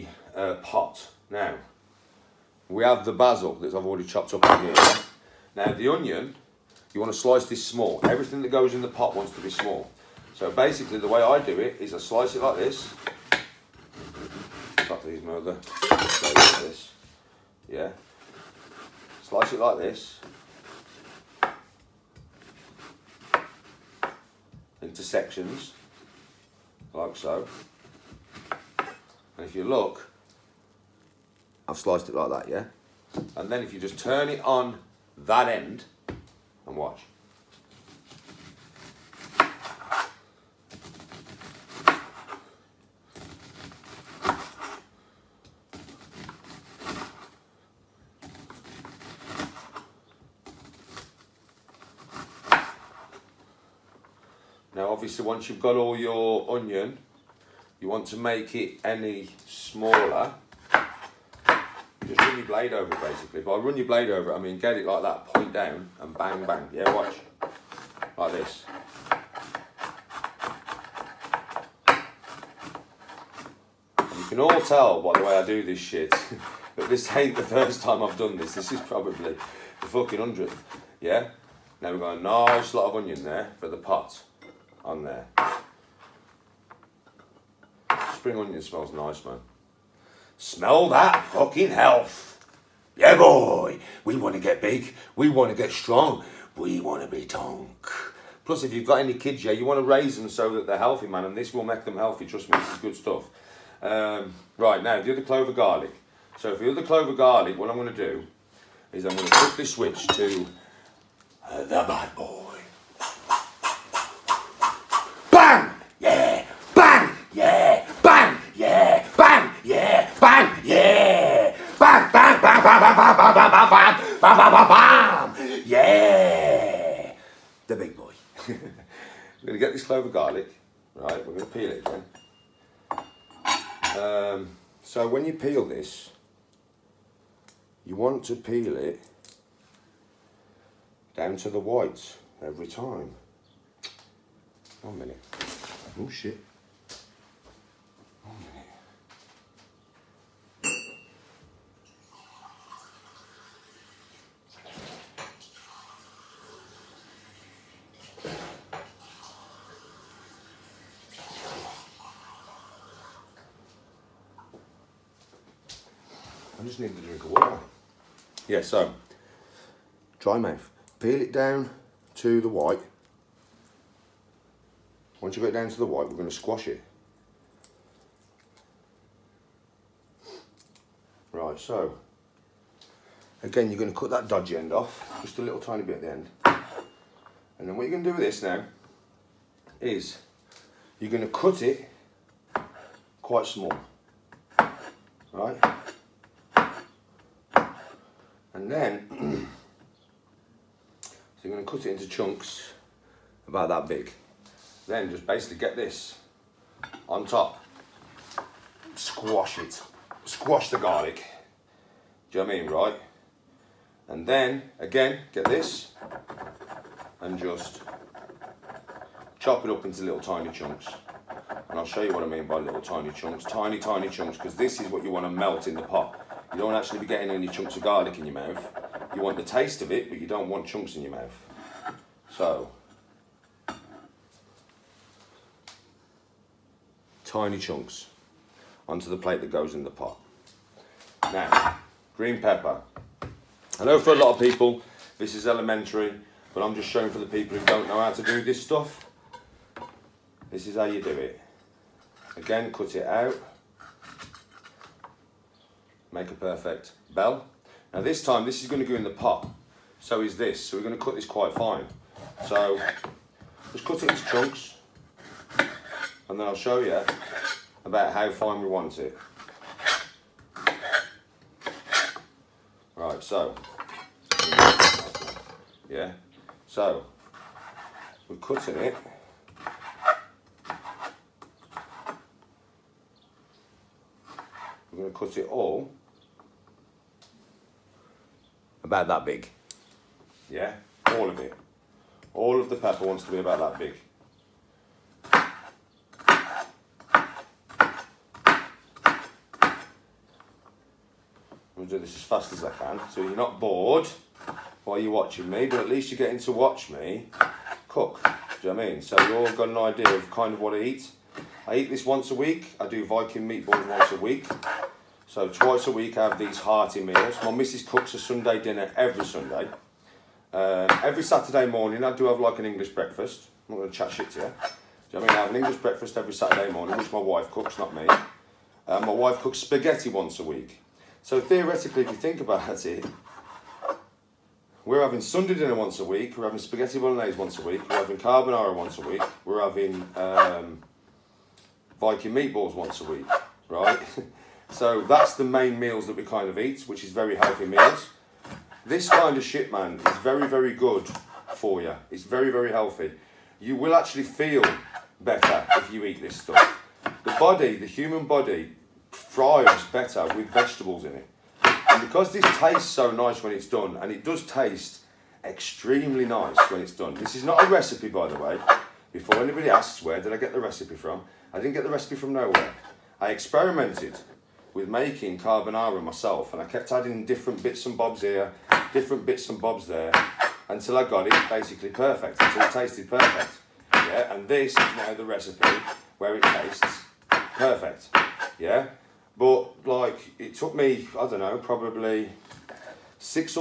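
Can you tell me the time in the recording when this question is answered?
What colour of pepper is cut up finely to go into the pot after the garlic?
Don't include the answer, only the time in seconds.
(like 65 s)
242 s.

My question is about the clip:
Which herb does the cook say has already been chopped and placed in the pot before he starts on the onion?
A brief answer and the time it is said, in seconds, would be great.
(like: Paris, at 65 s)
Basil, at 3 s.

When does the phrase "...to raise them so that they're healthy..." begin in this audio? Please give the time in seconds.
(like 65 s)
99 s.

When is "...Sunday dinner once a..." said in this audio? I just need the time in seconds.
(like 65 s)
335 s.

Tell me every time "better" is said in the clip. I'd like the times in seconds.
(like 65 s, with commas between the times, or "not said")
355 s, 359 s.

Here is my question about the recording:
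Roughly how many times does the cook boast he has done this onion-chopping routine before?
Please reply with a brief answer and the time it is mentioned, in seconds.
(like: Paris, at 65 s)
100, at 80 s.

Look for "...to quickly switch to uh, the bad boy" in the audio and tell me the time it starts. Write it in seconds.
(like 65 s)
109 s.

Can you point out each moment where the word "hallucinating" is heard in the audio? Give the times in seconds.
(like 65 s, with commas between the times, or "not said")
not said.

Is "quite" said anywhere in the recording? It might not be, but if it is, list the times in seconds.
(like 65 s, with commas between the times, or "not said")
193 s, 261 s.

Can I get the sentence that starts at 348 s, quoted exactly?
This kind of shit, man, is very, very good for you.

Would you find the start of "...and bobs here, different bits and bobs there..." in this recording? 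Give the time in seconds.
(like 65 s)
377 s.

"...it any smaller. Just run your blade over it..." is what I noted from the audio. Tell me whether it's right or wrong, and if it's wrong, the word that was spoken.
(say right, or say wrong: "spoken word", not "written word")
right.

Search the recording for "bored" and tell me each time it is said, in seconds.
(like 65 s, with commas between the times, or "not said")
303 s.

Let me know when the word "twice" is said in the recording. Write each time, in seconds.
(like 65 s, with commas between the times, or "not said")
315 s.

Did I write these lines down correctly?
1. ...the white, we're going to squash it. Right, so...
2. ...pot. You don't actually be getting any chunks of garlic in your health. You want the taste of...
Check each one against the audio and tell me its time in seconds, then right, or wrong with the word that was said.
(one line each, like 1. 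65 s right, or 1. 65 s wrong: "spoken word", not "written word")
1. 175 s right
2. 225 s wrong: "mouth", not "health".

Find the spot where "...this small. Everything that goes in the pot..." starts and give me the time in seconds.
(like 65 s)
7 s.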